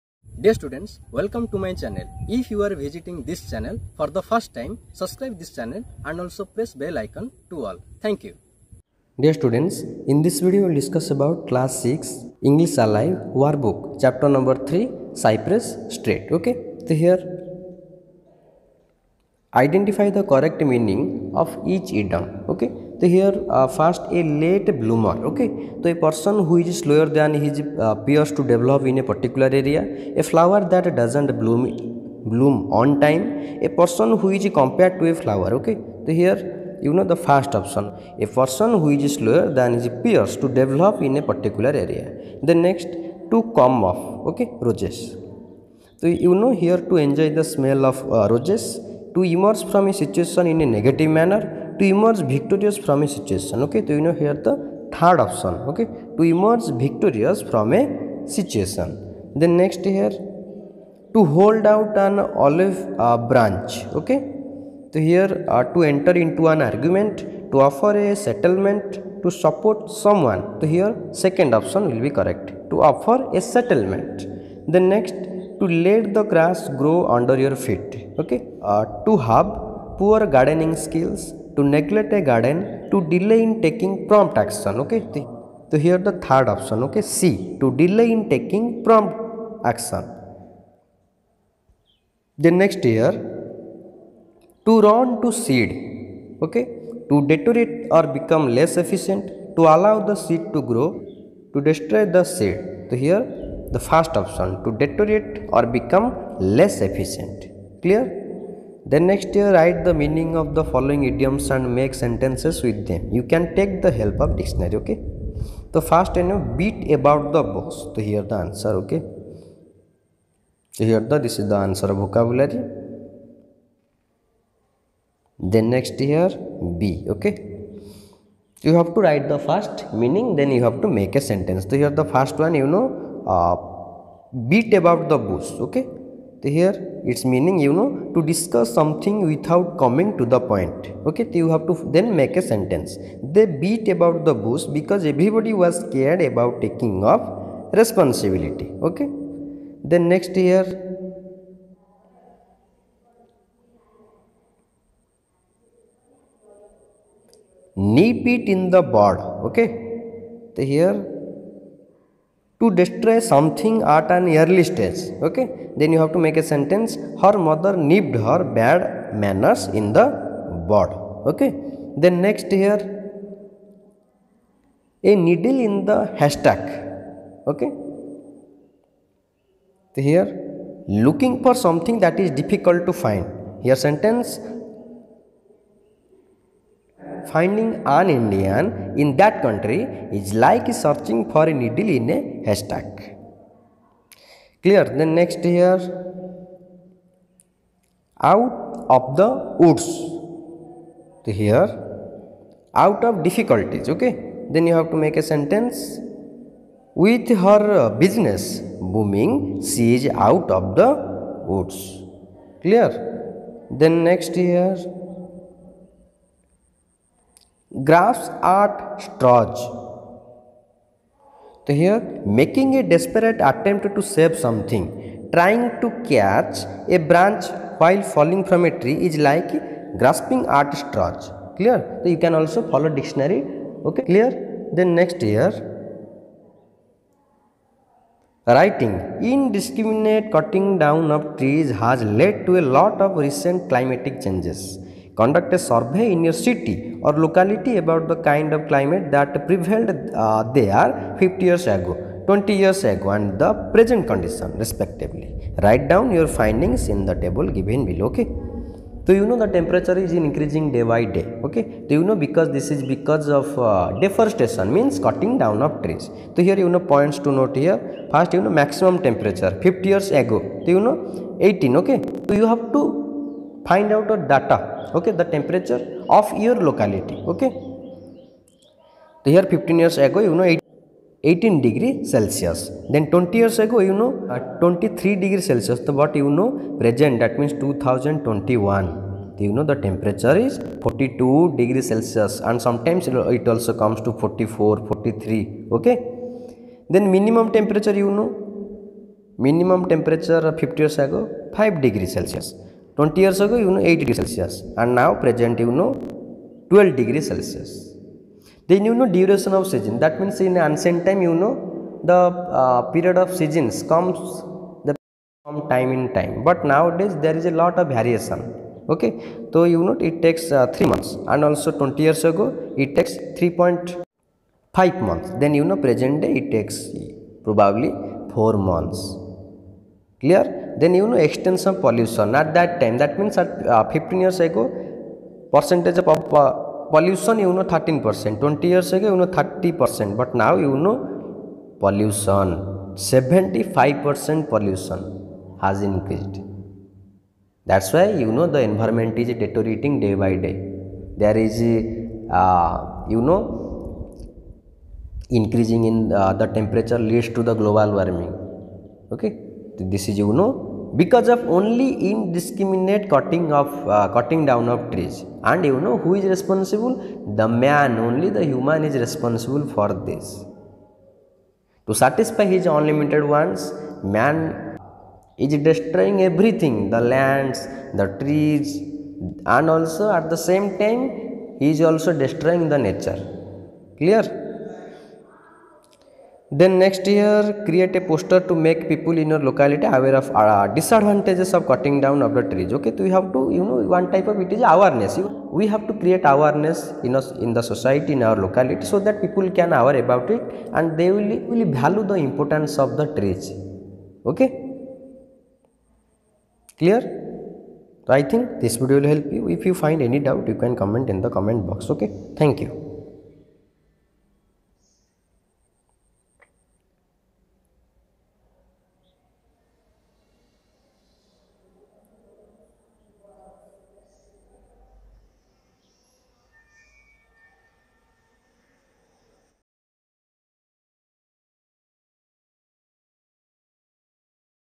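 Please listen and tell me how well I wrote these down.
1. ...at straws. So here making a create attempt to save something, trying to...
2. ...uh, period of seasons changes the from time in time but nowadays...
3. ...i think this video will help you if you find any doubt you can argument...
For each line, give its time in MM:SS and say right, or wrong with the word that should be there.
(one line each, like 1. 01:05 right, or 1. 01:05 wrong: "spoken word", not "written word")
1. 03:38 wrong: "desperate", not "create"
2. 05:12 wrong: "comes", not "changes"
3. 06:48 wrong: "comment", not "argument".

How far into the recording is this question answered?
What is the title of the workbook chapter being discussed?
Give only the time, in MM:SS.
00:15.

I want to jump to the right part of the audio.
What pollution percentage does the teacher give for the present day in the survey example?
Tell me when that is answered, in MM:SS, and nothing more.
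05:42.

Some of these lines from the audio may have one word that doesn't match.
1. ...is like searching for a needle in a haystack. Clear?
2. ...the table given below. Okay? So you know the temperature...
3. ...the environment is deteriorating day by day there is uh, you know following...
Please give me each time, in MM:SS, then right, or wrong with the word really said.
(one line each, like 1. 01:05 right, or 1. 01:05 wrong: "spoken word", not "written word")
1. 03:10 right
2. 04:17 right
3. 05:48 wrong: "increasing", not "following".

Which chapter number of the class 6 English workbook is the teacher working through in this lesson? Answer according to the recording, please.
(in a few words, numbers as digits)
3.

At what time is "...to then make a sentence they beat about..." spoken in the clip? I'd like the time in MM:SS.
02:21.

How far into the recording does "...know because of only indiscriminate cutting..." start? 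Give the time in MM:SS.
06:00.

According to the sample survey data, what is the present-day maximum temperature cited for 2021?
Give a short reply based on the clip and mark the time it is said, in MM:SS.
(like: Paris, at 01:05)
42 degrees Celsius, at 04:50.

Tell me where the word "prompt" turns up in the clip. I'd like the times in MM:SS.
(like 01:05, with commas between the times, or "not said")
01:24, 01:28.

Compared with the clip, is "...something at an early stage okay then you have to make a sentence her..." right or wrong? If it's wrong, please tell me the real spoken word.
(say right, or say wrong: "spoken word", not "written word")
right.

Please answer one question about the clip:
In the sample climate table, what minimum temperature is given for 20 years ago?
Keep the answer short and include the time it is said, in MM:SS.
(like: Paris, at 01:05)
8 degrees Celsius, at 05:03.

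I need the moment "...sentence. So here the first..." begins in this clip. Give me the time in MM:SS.
02:11.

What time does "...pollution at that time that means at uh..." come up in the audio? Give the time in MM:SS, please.
05:31.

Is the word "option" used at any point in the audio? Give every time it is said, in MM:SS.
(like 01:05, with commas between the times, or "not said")
00:55, 01:11, 01:26, 01:44.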